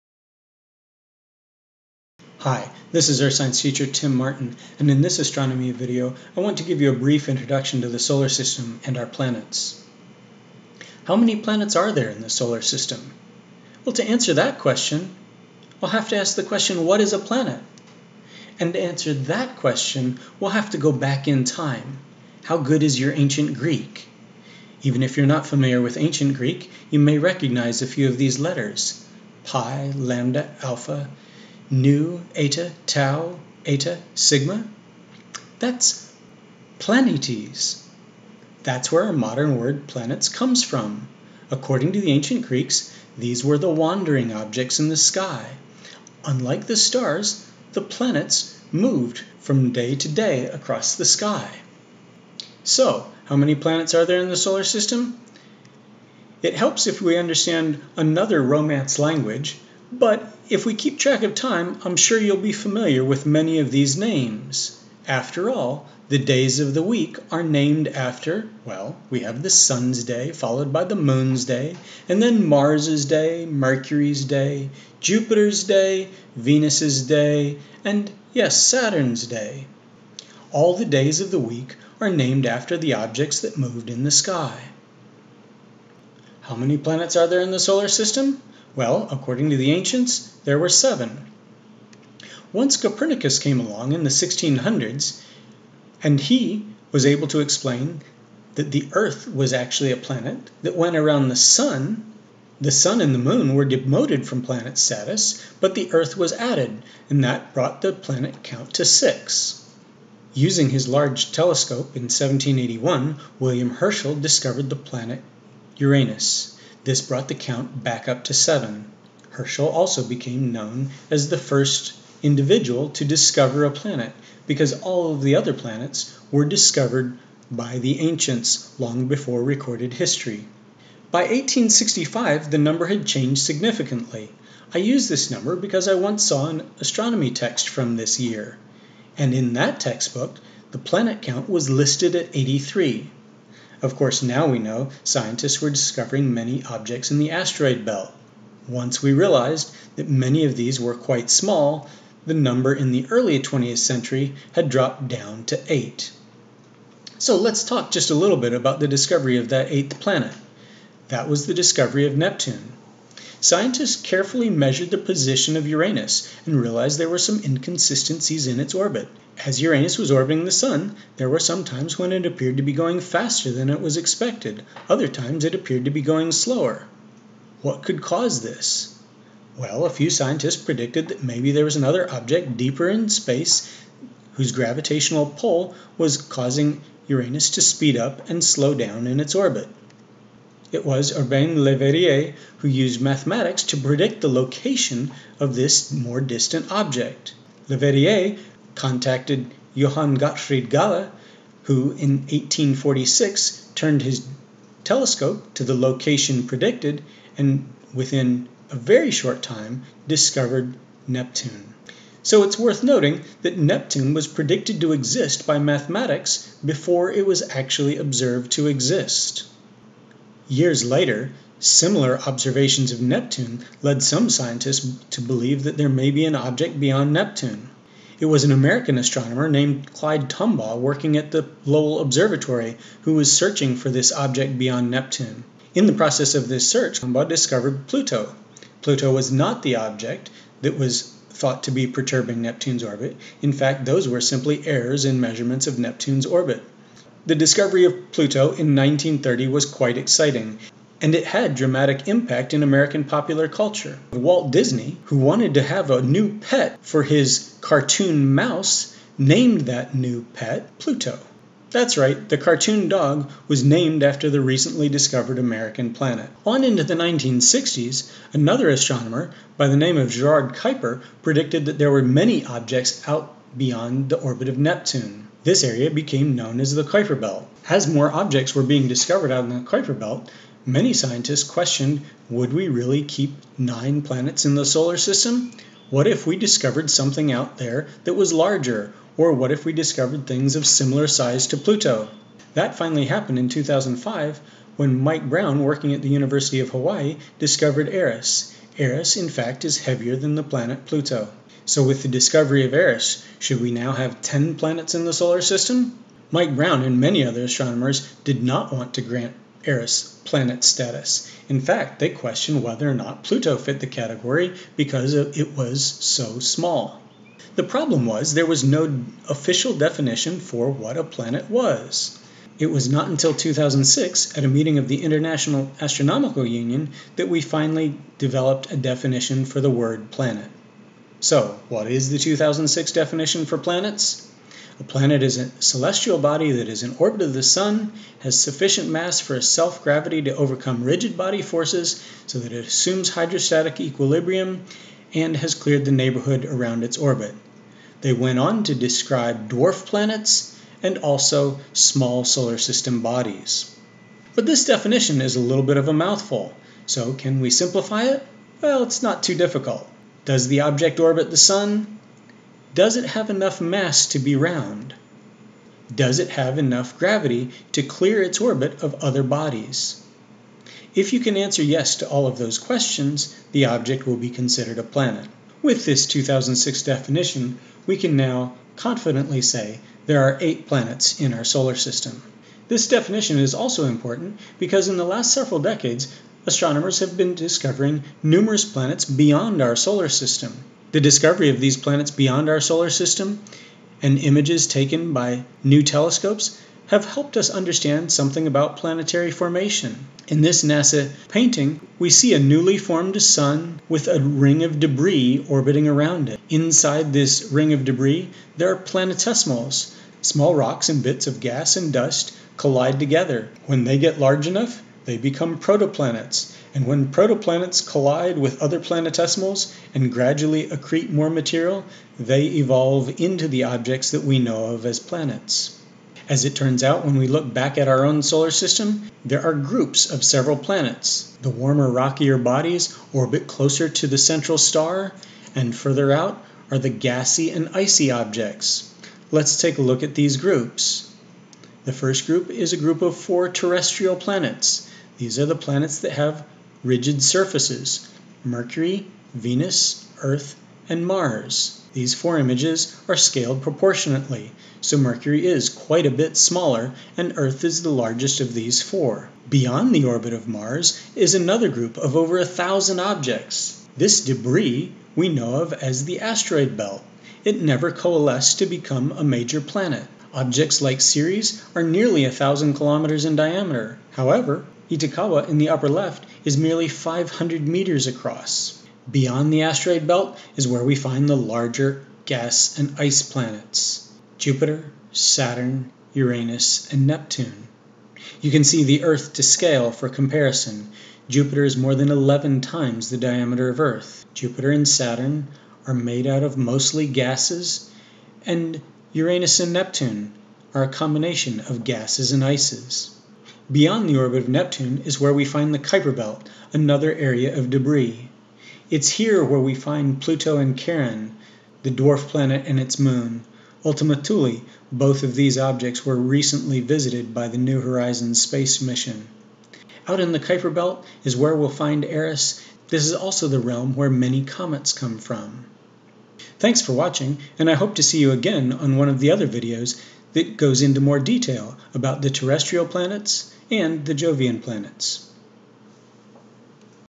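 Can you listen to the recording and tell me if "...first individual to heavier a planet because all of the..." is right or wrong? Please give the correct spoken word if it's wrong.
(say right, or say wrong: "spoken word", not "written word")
wrong: "discover", not "heavier".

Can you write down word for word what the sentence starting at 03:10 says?
It was Urbain Le Verrier who used mathematics to predict the location of this more distant object.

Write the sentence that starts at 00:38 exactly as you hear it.
That's where our modern word planets comes from.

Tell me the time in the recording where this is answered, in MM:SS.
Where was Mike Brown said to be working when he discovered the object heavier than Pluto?
04:56.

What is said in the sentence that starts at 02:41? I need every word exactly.
That was the discovery of Neptune scientists carefully measured the position of Uranus and realized there were some inconsistencies in its orbit.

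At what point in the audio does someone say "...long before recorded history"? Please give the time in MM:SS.
02:08.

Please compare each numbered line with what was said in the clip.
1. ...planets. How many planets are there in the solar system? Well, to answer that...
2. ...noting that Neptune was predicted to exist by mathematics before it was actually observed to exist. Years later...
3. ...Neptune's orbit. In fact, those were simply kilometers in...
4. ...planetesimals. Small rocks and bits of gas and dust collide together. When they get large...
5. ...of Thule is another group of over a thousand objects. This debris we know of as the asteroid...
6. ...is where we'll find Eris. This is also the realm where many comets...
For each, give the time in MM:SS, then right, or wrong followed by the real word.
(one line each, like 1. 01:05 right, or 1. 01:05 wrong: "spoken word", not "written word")
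1. 00:09 right
2. 03:32 right
3. 04:02 wrong: "errors", not "kilometers"
4. 06:48 right
5. 07:40 wrong: "Mars", not "Thule"
6. 08:41 right.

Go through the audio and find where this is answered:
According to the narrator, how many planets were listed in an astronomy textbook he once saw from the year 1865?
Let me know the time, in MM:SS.
02:22.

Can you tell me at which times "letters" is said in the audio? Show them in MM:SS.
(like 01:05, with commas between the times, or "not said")
00:28.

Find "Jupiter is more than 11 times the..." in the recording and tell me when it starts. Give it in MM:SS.
08:11.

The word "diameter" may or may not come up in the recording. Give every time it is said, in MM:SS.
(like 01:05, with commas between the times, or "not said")
07:53, 08:13.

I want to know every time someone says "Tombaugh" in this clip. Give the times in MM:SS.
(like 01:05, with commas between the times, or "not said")
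03:50, 03:57.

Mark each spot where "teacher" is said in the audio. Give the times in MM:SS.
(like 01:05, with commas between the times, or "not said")
00:03.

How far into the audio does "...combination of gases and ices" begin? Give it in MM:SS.
08:20.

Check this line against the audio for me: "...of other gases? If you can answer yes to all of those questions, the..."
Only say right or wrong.
wrong.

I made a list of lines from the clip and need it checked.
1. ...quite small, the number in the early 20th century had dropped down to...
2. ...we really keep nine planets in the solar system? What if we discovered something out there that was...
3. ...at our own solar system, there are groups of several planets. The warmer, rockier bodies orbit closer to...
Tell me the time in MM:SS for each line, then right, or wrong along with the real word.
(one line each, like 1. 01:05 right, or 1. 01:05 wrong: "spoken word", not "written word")
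1. 02:30 right
2. 04:42 right
3. 07:07 right.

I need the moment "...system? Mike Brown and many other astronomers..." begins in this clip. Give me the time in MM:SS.
05:05.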